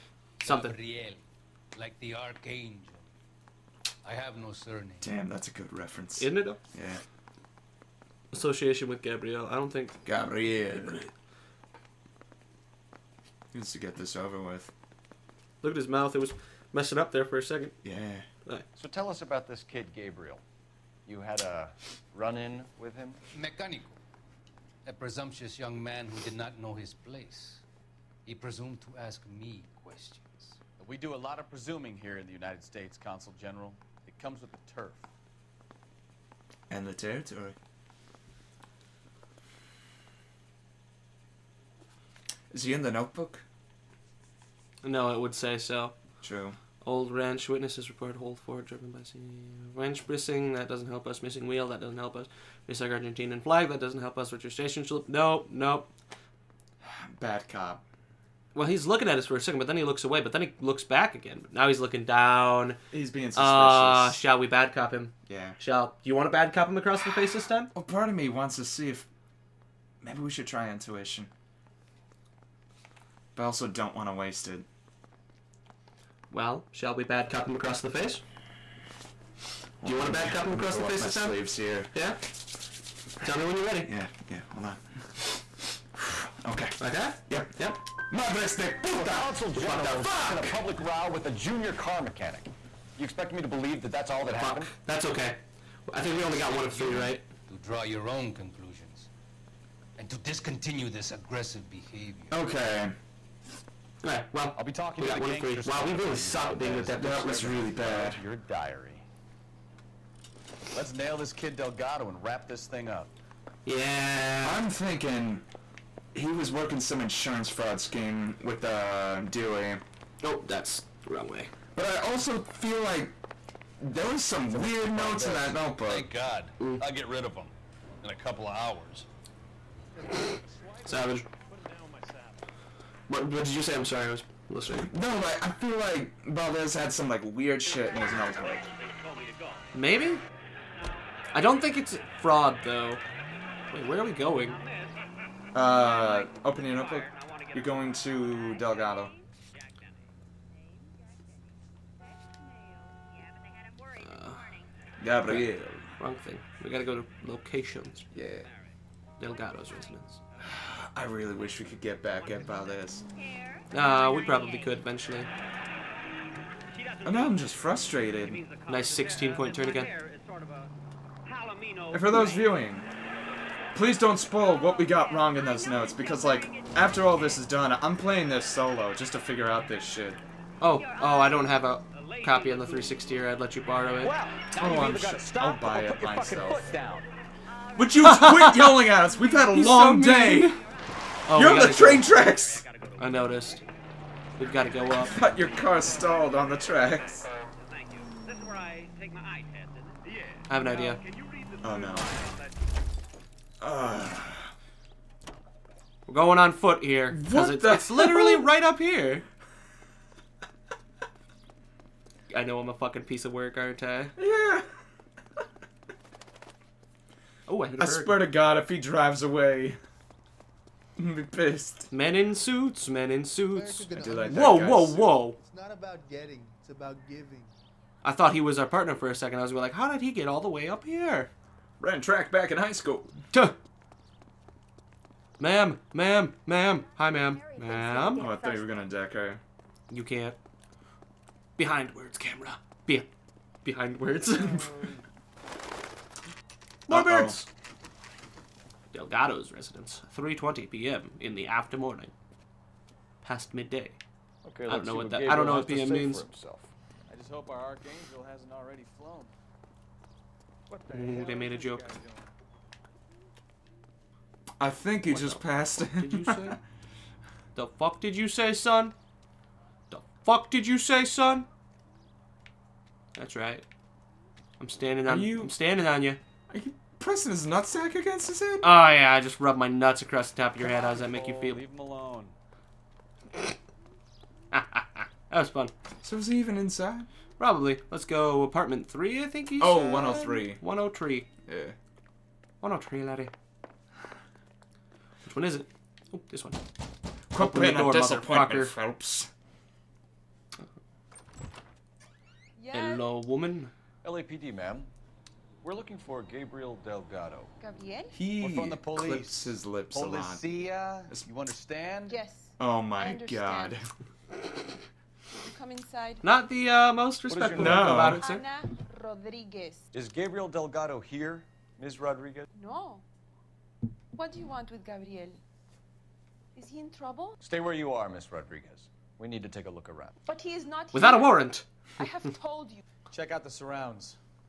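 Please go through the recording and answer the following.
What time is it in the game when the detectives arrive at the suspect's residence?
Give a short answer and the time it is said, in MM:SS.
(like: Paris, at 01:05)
3:20 p.m., at 04:10.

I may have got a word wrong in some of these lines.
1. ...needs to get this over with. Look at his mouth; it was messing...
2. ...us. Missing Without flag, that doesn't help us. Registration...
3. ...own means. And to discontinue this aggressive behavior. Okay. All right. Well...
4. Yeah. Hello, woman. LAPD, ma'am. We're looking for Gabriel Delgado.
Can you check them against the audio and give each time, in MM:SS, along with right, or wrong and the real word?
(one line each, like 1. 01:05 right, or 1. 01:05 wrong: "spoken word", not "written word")
1. 00:13 right
2. 00:52 wrong: "Argentinian", not "Without"
3. 01:38 wrong: "conclusions", not "means"
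4. 05:02 right.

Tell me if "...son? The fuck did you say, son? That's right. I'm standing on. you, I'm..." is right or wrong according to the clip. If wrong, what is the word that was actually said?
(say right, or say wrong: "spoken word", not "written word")
right.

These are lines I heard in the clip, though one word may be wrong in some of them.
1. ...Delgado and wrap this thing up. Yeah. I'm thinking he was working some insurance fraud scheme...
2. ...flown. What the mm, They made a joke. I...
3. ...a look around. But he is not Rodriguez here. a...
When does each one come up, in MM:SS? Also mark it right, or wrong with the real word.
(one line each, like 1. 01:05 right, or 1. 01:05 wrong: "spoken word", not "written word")
1. 01:51 right
2. 04:18 right
3. 05:29 wrong: "Without", not "Rodriguez".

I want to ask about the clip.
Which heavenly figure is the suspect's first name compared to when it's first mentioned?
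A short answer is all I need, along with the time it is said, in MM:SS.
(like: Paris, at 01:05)
The archangel, at 00:01.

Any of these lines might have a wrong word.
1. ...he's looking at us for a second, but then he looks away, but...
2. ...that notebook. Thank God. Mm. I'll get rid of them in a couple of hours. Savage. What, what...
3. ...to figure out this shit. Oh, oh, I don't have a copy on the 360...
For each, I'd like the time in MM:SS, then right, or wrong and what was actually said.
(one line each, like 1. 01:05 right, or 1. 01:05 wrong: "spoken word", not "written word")
1. 00:58 right
2. 02:05 right
3. 02:59 right.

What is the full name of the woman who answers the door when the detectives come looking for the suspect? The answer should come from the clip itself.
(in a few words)
Ana Rodriguez.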